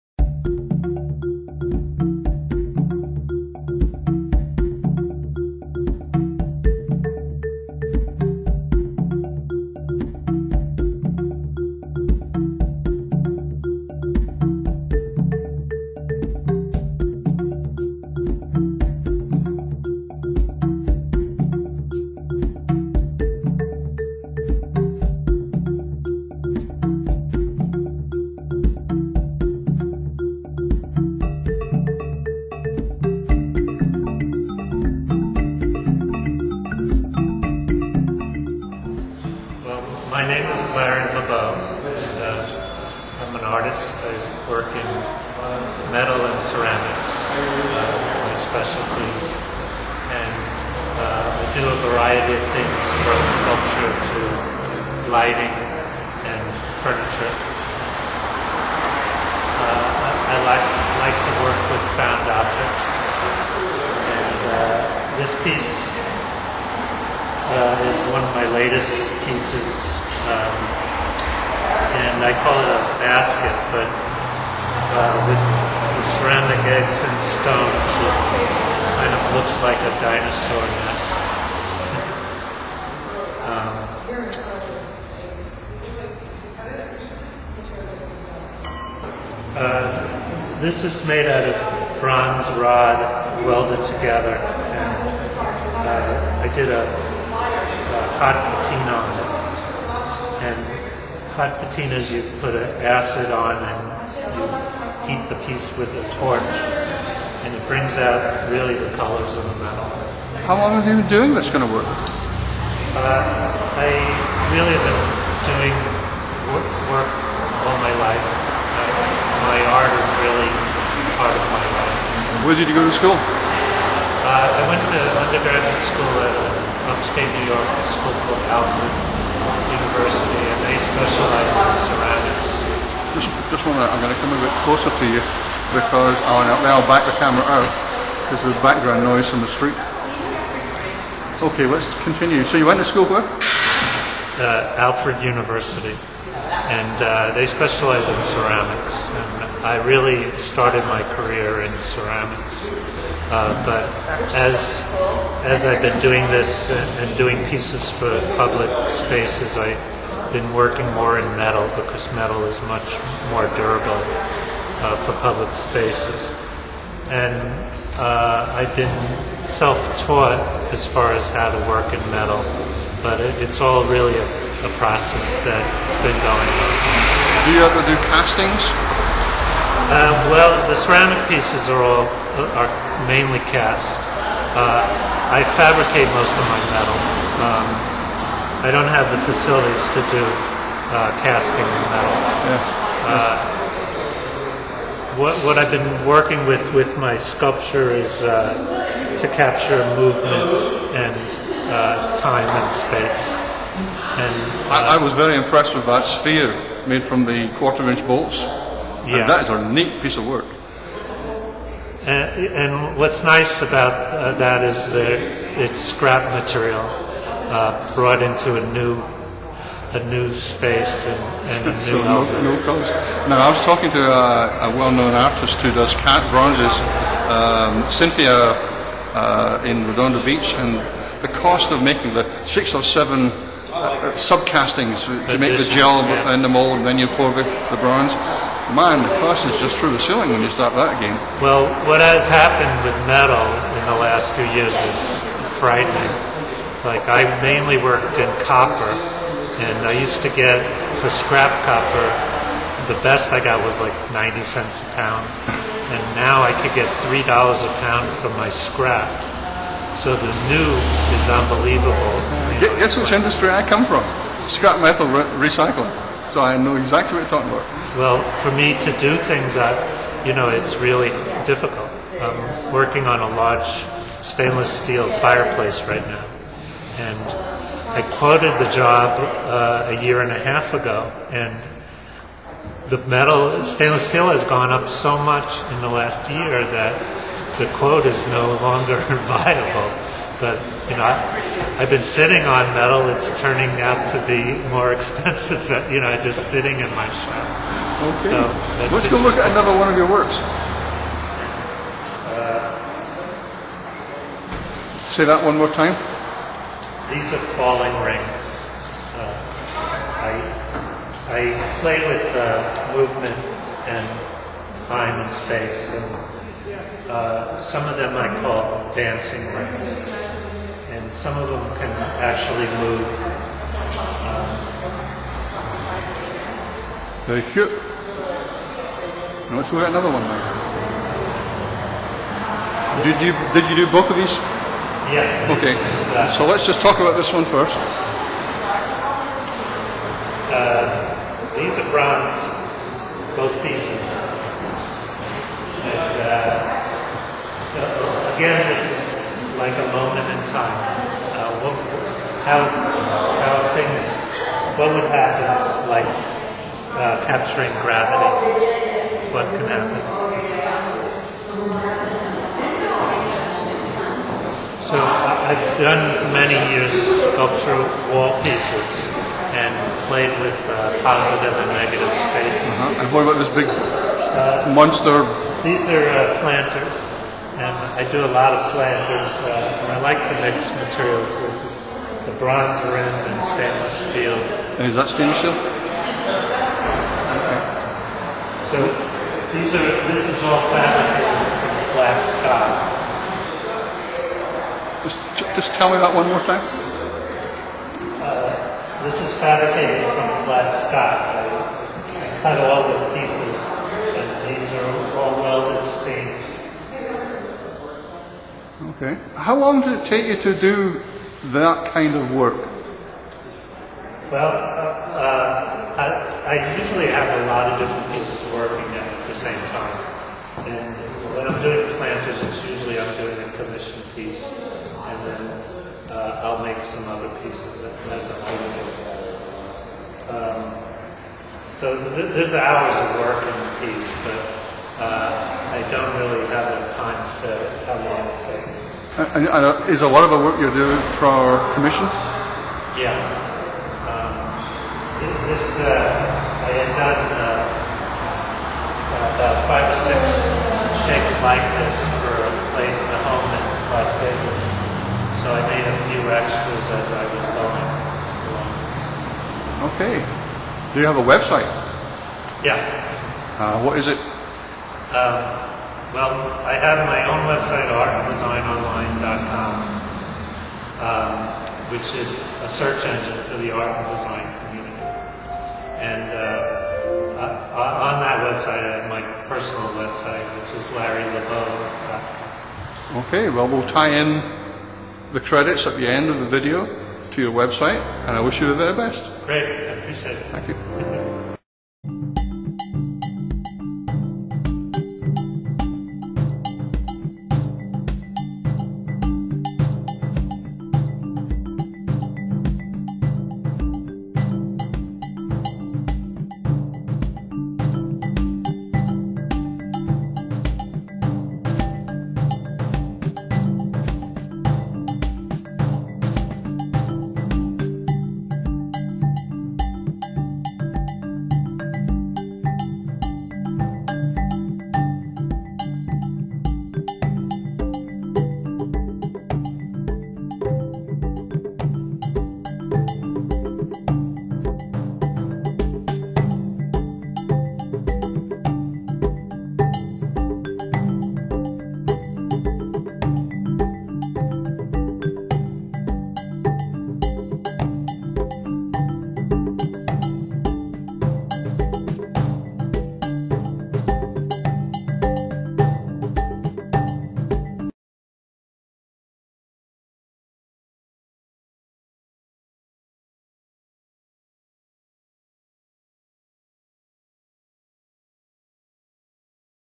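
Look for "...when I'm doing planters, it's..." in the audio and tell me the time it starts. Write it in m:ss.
7:01.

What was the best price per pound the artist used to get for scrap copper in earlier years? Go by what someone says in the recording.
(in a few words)
90 cents.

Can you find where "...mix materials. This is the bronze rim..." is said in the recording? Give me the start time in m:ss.
6:20.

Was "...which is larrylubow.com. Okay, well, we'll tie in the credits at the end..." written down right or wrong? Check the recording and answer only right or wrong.
right.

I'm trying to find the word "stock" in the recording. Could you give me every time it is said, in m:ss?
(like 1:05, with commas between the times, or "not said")
6:32, 6:40.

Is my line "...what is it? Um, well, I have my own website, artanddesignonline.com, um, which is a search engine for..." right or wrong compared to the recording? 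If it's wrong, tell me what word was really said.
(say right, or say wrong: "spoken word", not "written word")
right.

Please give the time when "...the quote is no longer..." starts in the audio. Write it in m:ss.
4:47.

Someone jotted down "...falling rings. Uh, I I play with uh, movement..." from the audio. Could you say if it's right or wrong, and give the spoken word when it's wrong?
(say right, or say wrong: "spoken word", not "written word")
right.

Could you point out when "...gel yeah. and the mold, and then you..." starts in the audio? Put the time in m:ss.
3:55.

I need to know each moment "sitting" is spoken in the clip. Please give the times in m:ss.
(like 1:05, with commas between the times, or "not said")
4:52, 4:56.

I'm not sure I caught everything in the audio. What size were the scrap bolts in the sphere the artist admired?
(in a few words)
quarter-inch.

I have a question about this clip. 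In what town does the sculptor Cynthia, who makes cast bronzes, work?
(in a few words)
Redondo Beach.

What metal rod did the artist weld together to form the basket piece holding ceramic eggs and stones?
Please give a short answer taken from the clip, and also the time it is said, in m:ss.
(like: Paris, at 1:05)
bronze rod, at 1:32.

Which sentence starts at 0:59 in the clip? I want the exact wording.
Uh, I like, like to work with found objects.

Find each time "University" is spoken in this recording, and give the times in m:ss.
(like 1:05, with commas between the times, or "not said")
2:09, 2:25.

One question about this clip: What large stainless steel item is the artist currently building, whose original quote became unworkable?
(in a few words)
fireplace.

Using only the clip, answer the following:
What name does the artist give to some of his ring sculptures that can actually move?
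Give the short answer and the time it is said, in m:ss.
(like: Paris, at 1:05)
dancing rings, at 5:18.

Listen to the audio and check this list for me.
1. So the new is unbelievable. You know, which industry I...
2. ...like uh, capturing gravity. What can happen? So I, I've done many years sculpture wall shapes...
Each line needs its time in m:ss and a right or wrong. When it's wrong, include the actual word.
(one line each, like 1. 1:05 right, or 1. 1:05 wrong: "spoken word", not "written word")
1. 4:19 right
2. 5:55 wrong: "pieces", not "shapes".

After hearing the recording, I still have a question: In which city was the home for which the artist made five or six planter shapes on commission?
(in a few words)
Las Vegas.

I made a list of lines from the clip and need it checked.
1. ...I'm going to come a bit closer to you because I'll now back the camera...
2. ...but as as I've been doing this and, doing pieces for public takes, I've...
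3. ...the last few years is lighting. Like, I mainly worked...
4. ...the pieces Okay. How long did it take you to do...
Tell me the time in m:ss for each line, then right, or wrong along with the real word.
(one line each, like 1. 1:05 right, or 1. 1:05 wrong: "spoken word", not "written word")
1. 2:13 right
2. 2:33 wrong: "spaces", not "takes"
3. 4:03 wrong: "frightening", not "lighting"
4. 6:42 right.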